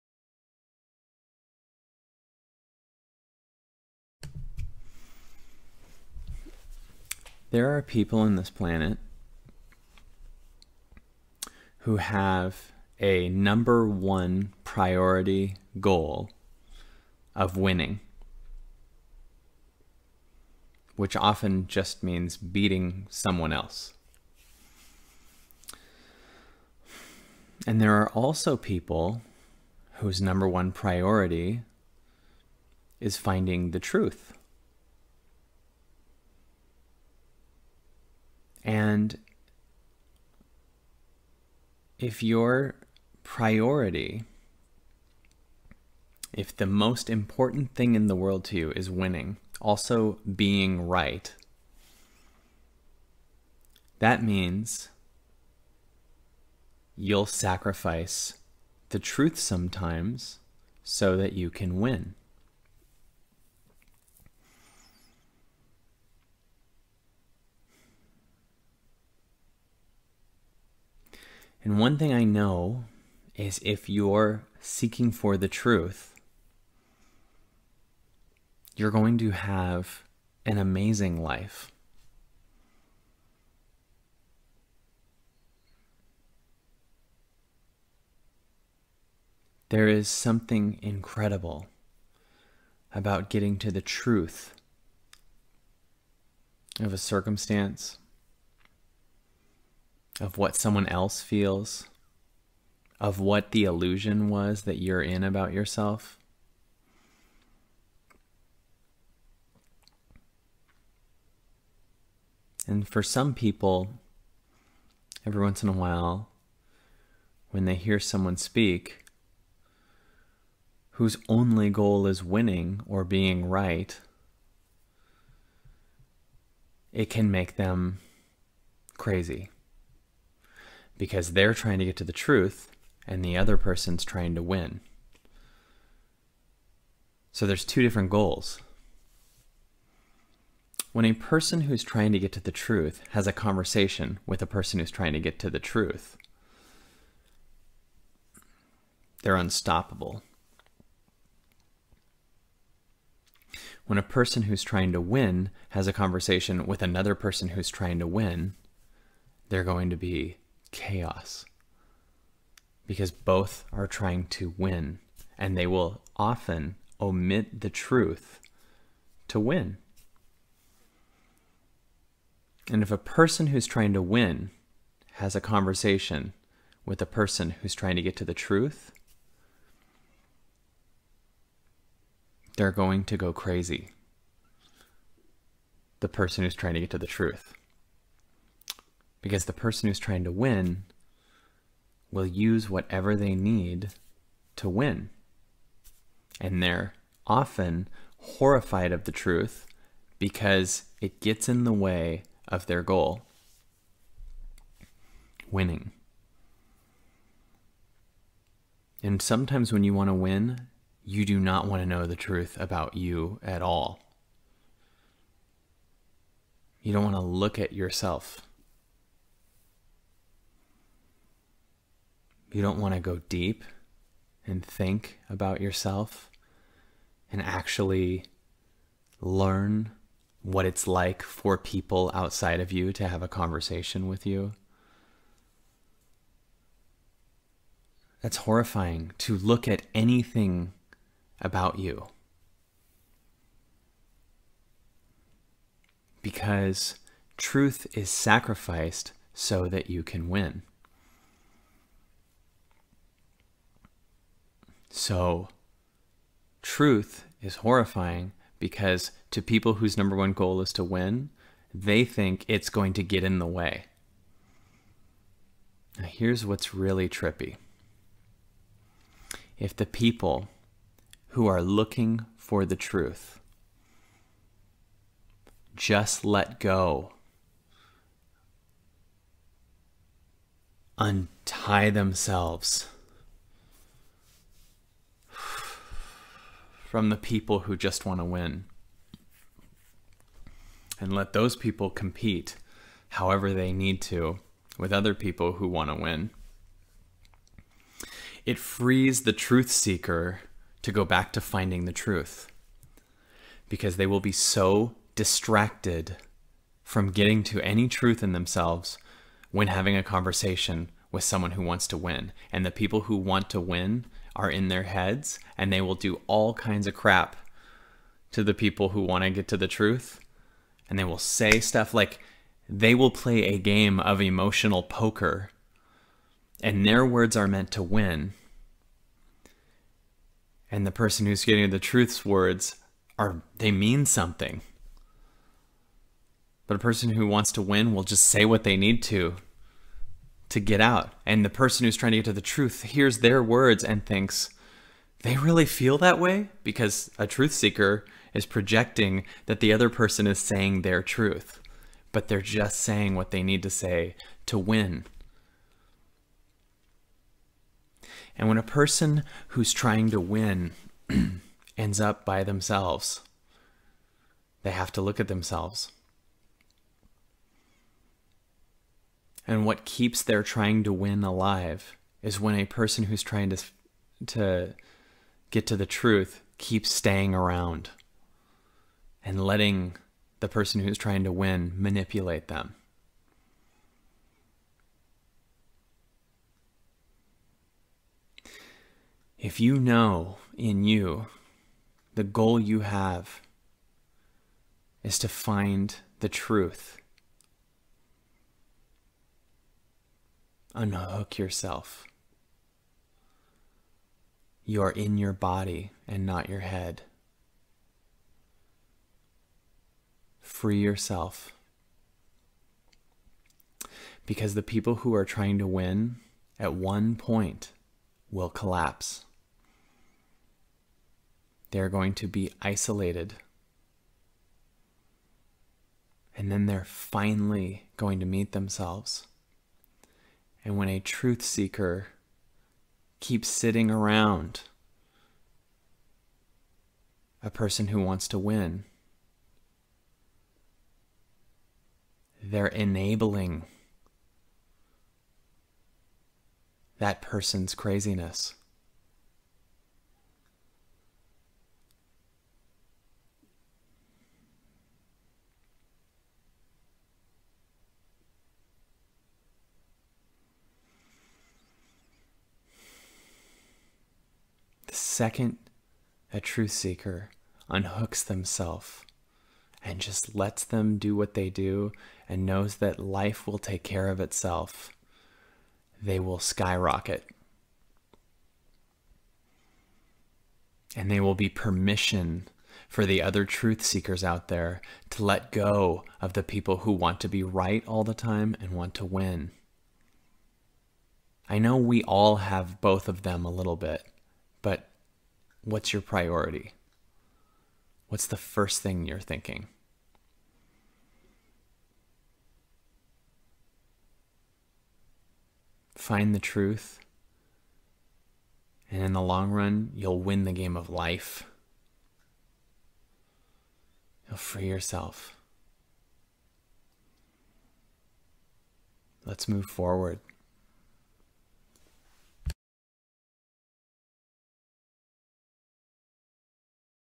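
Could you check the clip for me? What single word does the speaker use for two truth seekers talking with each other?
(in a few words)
unstoppable.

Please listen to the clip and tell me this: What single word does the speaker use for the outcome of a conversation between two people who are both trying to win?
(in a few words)
chaos.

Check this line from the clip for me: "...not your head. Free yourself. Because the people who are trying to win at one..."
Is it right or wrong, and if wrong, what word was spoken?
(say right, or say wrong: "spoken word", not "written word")
right.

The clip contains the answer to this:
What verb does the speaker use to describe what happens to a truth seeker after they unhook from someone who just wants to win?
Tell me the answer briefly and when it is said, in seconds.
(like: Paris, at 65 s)
skyrocket, at 476 s.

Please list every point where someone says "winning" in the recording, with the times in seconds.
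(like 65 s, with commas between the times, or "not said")
17 s, 48 s, 122 s, 205 s.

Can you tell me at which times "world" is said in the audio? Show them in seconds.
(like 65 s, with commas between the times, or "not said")
48 s.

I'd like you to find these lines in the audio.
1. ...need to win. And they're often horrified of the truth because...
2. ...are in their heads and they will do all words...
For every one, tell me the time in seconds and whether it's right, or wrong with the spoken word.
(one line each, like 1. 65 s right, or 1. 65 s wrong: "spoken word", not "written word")
1. 193 s right
2. 314 s wrong: "kinds", not "words".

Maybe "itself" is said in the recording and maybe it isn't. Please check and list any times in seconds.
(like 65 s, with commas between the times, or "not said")
474 s.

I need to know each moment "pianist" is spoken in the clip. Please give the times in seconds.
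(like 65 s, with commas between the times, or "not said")
not said.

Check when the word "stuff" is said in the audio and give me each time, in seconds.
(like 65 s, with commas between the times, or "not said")
321 s.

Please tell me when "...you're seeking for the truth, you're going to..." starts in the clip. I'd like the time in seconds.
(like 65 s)
73 s.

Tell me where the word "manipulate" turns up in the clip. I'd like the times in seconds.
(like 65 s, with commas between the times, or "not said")
381 s.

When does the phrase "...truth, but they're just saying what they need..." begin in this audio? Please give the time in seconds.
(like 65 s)
351 s.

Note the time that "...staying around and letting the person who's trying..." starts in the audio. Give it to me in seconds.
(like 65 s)
376 s.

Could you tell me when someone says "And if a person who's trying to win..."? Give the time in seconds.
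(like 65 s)
172 s.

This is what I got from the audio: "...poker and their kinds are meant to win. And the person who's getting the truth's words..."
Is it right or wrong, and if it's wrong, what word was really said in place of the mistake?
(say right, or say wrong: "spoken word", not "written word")
wrong: "words", not "kinds".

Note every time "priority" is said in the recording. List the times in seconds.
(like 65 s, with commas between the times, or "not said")
14 s, 30 s, 43 s, 496 s.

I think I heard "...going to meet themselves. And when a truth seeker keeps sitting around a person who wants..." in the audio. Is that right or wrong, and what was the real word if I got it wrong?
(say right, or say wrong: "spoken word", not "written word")
right.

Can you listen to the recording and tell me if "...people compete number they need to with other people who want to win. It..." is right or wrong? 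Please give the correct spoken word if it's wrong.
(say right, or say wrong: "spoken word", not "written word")
wrong: "however", not "number".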